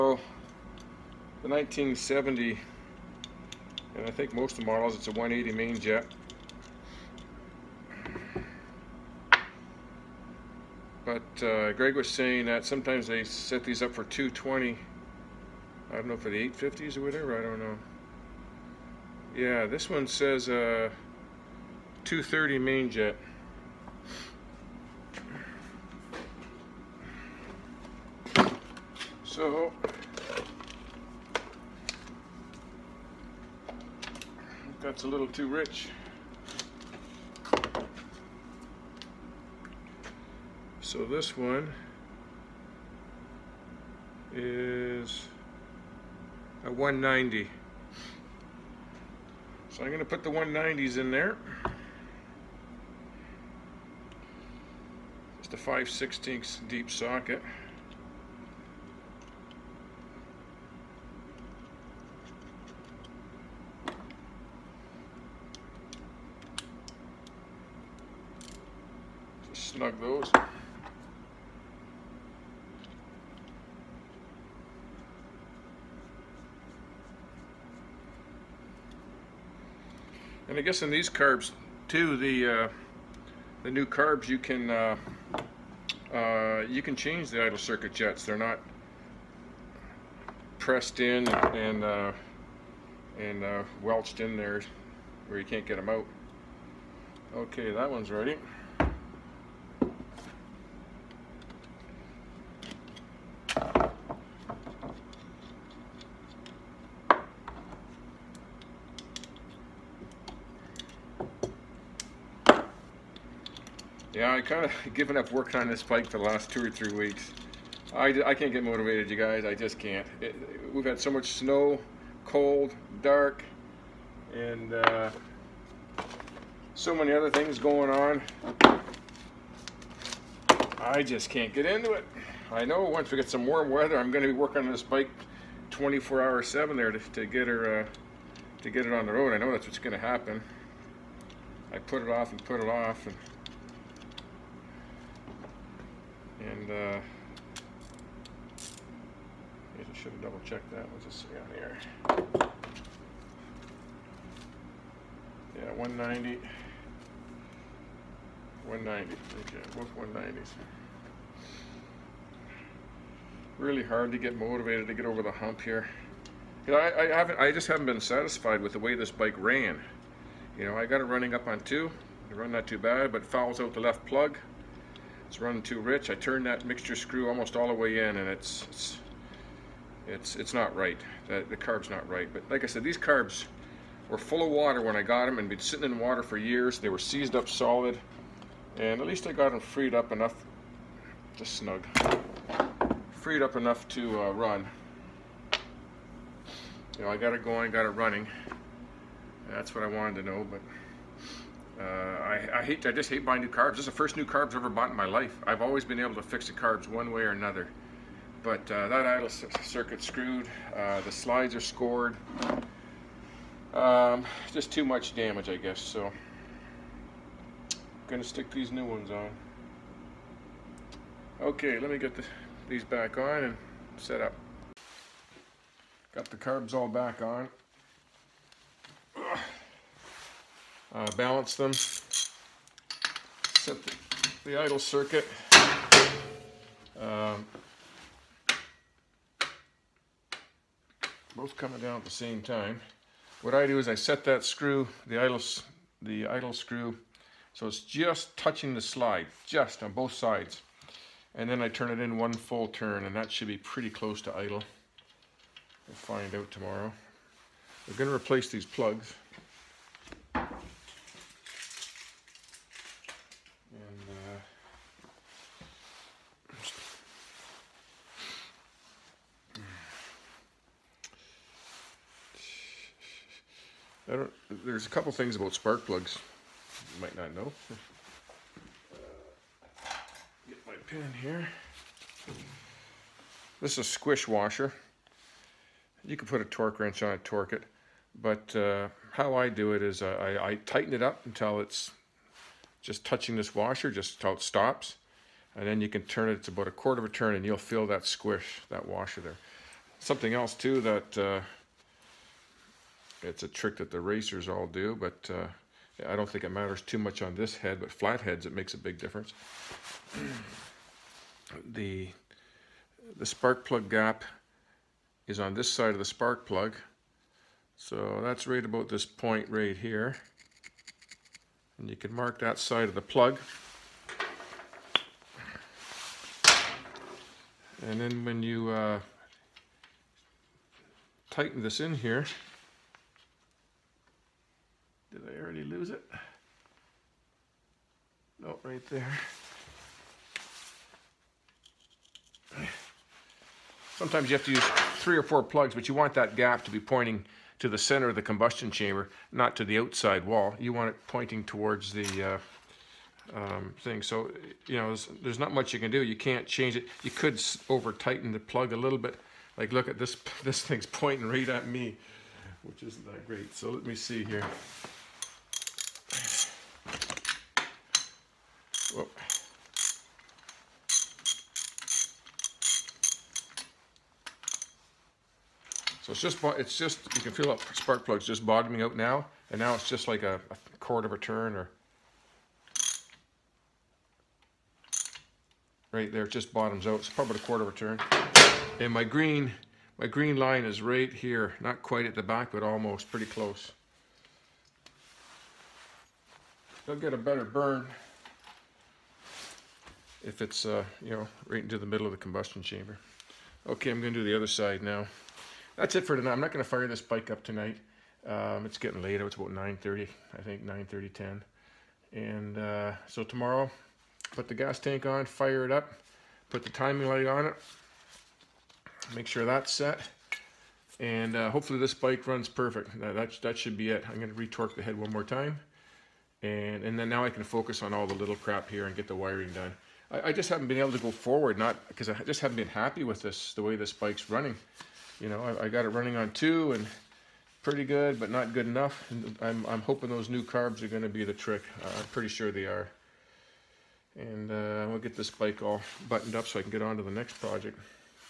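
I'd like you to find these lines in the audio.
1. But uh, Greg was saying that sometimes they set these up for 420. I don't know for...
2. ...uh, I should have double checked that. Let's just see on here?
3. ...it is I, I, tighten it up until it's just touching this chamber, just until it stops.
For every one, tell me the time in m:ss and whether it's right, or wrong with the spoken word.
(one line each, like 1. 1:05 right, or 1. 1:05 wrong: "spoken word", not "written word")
1. 0:11 wrong: "220", not "420"
2. 2:26 right
3. 4:49 wrong: "washer", not "chamber".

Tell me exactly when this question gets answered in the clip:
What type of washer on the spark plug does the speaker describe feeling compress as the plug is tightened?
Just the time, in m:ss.
4:43.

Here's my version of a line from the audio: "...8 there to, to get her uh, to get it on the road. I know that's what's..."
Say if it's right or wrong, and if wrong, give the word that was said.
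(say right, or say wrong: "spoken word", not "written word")
wrong: "7", not "8".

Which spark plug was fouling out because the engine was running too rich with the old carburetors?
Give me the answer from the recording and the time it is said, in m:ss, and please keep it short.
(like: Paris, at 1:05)
Left plug, at 2:53.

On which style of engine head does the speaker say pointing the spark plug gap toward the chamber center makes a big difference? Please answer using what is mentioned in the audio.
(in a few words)
Flatheads.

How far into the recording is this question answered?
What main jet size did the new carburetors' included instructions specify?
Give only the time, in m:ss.
0:22.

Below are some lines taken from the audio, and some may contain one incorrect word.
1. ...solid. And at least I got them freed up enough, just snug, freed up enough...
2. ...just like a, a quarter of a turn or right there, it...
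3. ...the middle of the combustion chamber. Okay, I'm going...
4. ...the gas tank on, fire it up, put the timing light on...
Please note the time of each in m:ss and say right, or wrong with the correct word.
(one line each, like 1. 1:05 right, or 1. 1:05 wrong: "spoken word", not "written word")
1. 3:07 right
2. 6:19 right
3. 6:41 right
4. 6:54 right.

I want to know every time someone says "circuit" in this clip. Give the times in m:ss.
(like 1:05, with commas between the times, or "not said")
1:27, 3:29, 3:54.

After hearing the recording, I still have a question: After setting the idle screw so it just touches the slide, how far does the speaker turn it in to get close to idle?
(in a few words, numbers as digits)
One full turn.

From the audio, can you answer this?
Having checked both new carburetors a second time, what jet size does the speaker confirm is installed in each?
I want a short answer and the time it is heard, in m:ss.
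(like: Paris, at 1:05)
190, at 2:38.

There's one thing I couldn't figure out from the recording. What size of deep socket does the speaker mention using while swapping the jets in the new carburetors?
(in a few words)
5/16.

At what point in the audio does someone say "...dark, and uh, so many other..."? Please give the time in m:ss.
2:03.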